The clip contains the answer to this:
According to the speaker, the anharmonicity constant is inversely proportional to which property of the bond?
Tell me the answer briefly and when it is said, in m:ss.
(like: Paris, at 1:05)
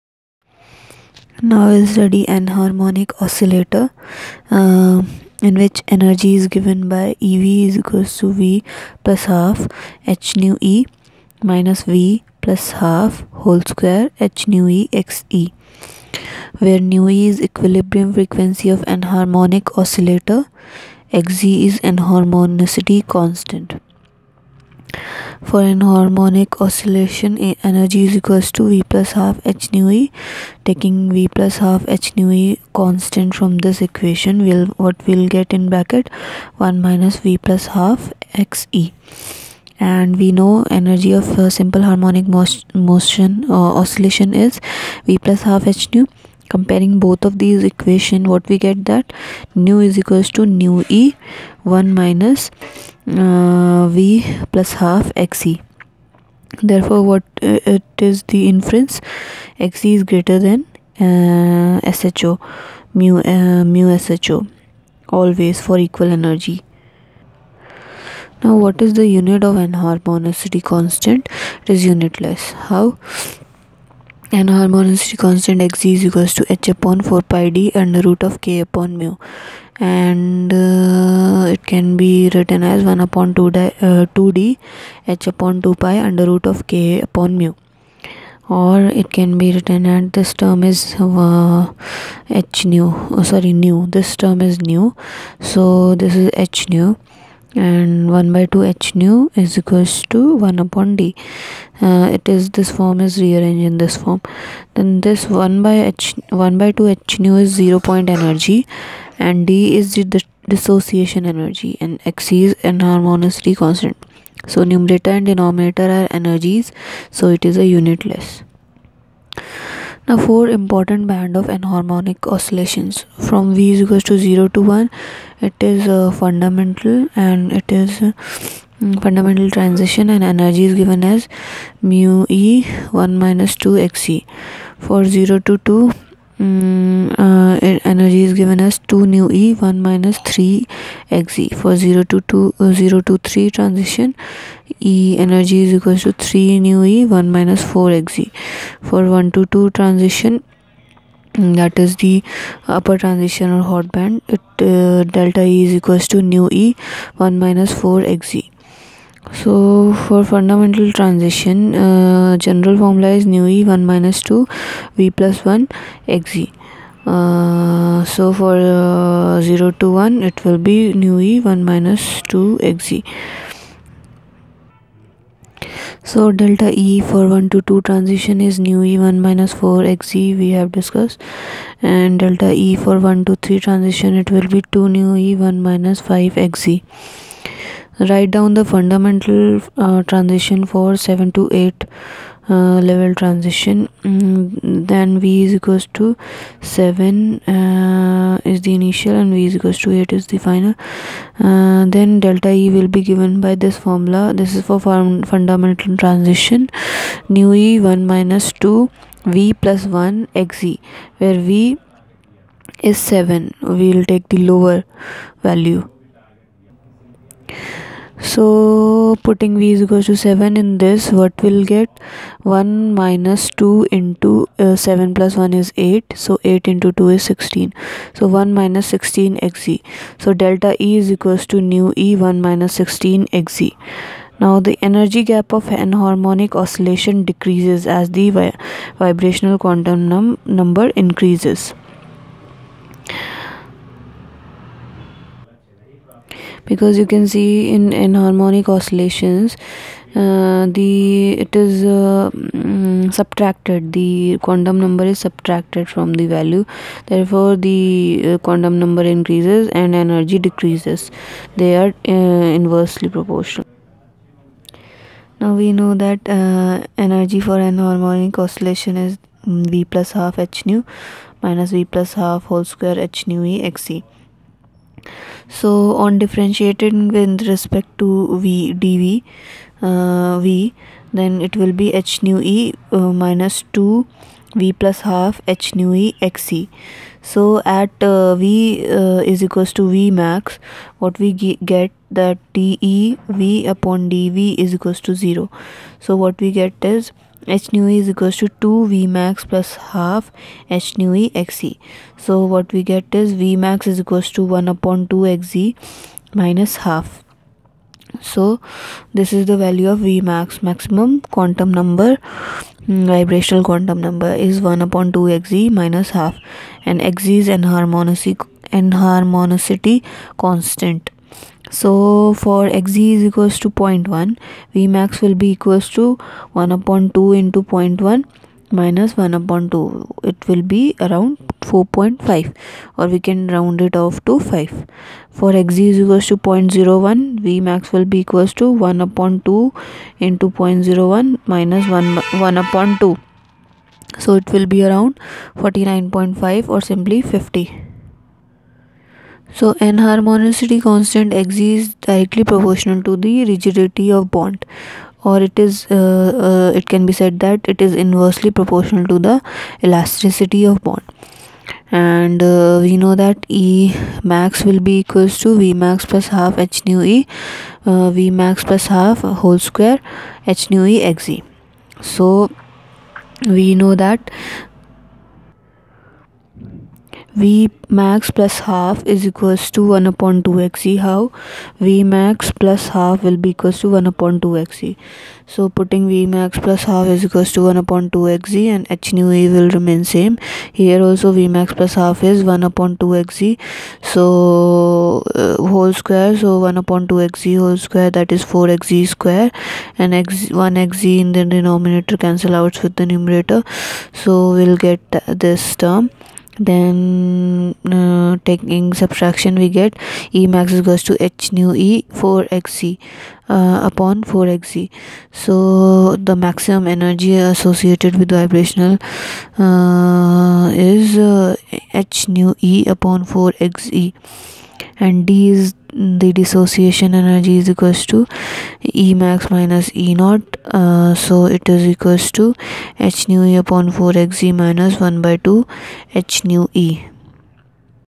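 elasticity, at 5:59.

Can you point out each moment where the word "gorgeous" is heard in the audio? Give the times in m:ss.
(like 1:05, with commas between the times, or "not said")
not said.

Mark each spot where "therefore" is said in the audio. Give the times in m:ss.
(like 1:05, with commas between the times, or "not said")
0:56, 4:17.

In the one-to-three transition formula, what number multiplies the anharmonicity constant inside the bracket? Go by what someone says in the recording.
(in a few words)
5.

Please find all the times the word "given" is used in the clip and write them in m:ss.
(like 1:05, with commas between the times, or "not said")
0:06, 2:10, 2:18, 3:23.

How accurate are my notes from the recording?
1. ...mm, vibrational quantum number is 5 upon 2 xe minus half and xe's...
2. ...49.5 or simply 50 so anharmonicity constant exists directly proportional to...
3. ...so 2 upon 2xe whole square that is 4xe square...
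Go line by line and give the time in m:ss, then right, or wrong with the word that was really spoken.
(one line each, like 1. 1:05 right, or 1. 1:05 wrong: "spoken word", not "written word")
1. 5:12 wrong: "1", not "5"
2. 5:45 right
3. 6:36 wrong: "1", not "2".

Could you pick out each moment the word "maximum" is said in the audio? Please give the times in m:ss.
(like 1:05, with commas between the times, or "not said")
5:10, 6:56.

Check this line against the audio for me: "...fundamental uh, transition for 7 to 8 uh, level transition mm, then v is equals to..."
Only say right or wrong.
right.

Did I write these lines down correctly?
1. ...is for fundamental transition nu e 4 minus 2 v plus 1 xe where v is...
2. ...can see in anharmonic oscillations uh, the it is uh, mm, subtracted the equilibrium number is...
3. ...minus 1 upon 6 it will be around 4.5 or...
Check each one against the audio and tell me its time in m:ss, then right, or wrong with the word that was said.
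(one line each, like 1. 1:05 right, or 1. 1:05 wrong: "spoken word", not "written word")
1. 3:24 wrong: "1", not "4"
2. 4:07 wrong: "quantum", not "equilibrium"
3. 5:28 wrong: "2", not "6".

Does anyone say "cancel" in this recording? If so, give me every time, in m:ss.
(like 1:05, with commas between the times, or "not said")
6:42.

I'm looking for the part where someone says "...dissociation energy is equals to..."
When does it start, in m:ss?
7:06.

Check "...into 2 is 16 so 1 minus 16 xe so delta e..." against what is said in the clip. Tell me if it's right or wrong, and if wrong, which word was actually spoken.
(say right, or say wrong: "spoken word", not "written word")
right.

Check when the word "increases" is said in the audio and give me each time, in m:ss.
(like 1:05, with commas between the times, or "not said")
4:01, 4:19.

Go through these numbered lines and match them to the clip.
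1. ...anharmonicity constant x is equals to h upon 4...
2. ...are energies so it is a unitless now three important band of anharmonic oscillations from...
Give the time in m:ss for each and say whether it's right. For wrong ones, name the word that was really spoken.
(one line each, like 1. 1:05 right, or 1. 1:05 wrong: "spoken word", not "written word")
1. 1:14 right
2. 1:55 wrong: "four", not "three".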